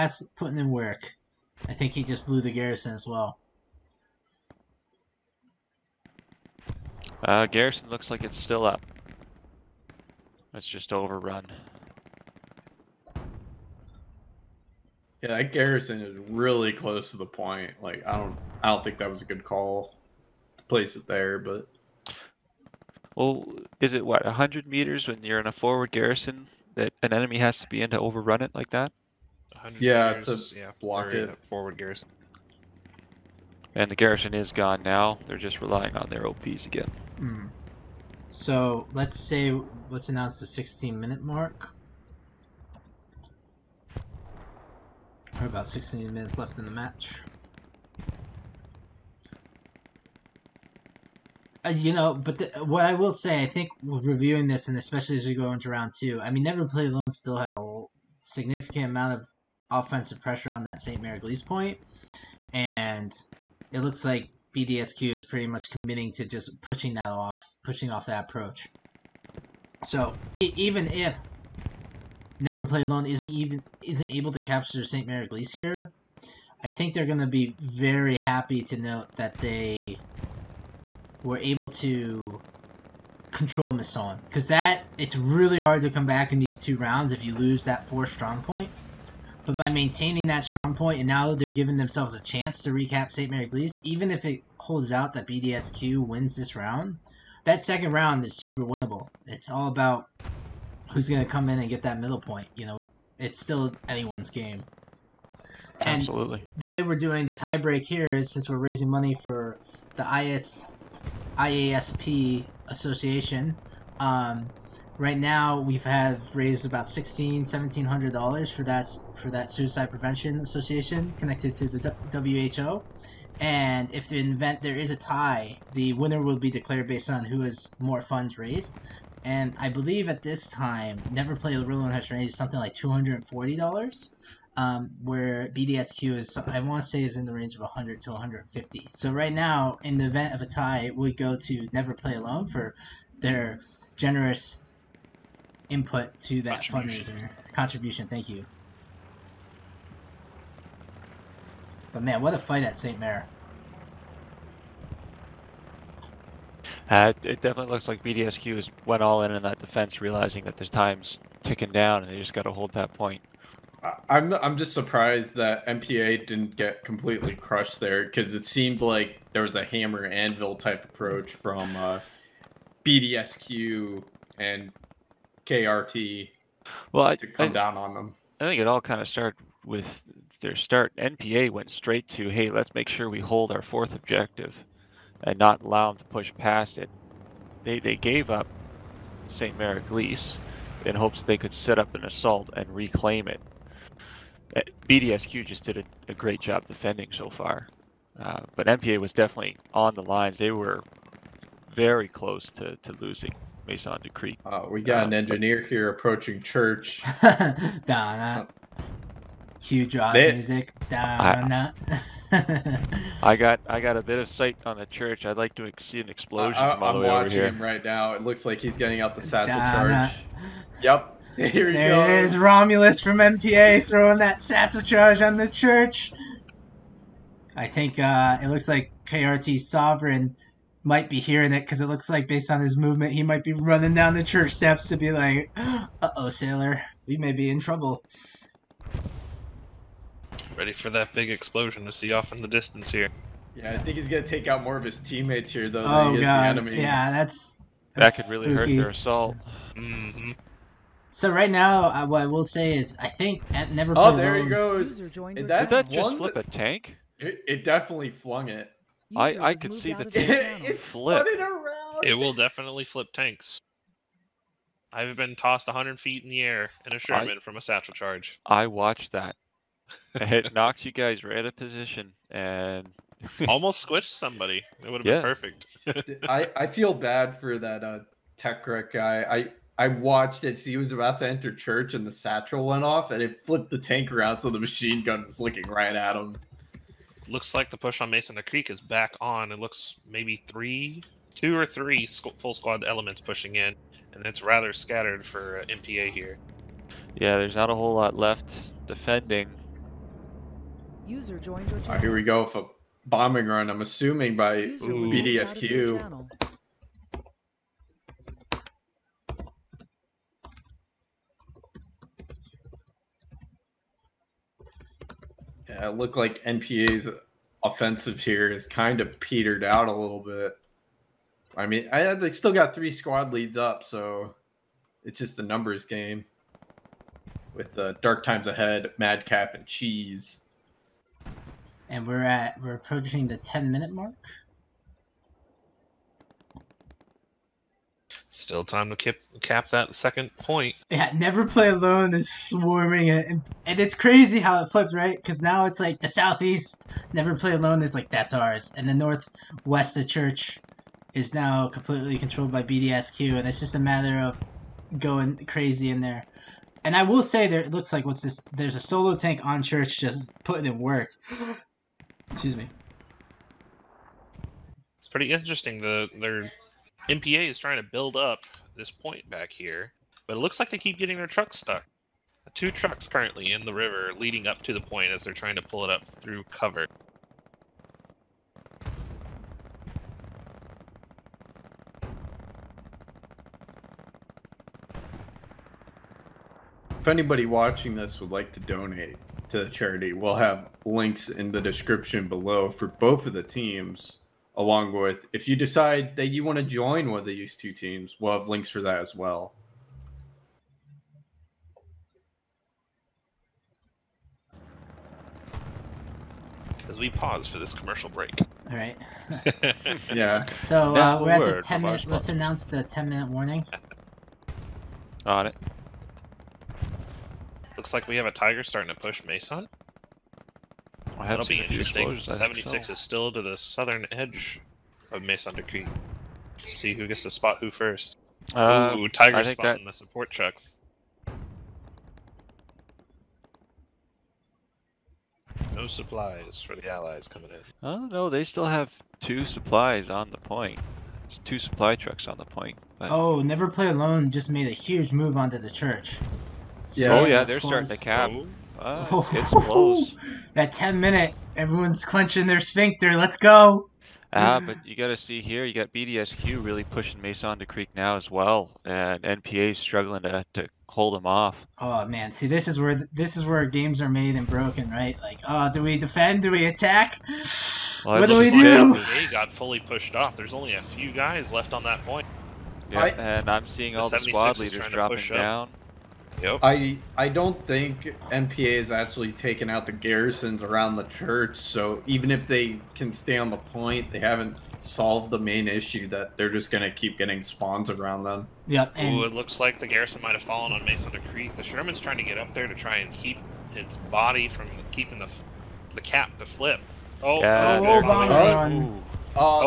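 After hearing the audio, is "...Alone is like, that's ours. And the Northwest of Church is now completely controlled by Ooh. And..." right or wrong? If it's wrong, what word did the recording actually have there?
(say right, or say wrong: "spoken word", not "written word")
wrong: "BDSQ", not "Ooh".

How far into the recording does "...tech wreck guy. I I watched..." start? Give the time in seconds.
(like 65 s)
278 s.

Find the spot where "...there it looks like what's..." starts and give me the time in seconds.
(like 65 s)
357 s.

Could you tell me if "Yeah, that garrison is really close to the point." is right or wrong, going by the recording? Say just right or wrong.
right.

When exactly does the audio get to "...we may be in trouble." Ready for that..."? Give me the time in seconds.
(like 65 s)
237 s.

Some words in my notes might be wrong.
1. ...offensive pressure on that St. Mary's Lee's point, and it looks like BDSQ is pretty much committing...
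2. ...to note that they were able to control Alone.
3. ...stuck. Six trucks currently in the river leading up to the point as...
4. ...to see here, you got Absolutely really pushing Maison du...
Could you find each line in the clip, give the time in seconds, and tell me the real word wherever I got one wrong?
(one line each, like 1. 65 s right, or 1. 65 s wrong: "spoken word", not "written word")
1. 59 s right
2. 78 s wrong: "Masson", not "Alone"
3. 371 s wrong: "Two", not "Six"
4. 455 s wrong: "BDSQ", not "Absolutely".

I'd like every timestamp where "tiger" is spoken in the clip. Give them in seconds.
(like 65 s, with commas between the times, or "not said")
418 s, 429 s.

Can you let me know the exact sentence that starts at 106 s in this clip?
The way we're doing the tie break here is since we're raising money for the IS IASP association.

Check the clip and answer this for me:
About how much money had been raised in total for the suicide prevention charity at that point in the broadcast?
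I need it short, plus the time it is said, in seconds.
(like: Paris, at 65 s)
$1,600-1,700, at 116 s.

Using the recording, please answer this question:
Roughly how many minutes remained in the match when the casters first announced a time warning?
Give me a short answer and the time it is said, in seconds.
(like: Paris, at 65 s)
16 minutes, at 40 s.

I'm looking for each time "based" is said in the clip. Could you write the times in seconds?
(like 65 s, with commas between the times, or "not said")
126 s, 232 s.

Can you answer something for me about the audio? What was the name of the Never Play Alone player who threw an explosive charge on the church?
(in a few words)
Romulus.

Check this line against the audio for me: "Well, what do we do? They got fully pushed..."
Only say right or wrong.
right.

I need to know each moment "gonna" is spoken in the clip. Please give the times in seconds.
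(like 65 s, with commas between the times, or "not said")
244 s, 486 s.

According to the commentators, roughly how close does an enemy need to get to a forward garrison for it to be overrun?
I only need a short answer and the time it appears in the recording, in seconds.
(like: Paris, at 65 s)
100 meters, at 24 s.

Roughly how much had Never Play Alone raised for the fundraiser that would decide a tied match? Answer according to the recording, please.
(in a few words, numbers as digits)
$240.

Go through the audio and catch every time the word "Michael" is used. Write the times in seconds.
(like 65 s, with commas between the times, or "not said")
not said.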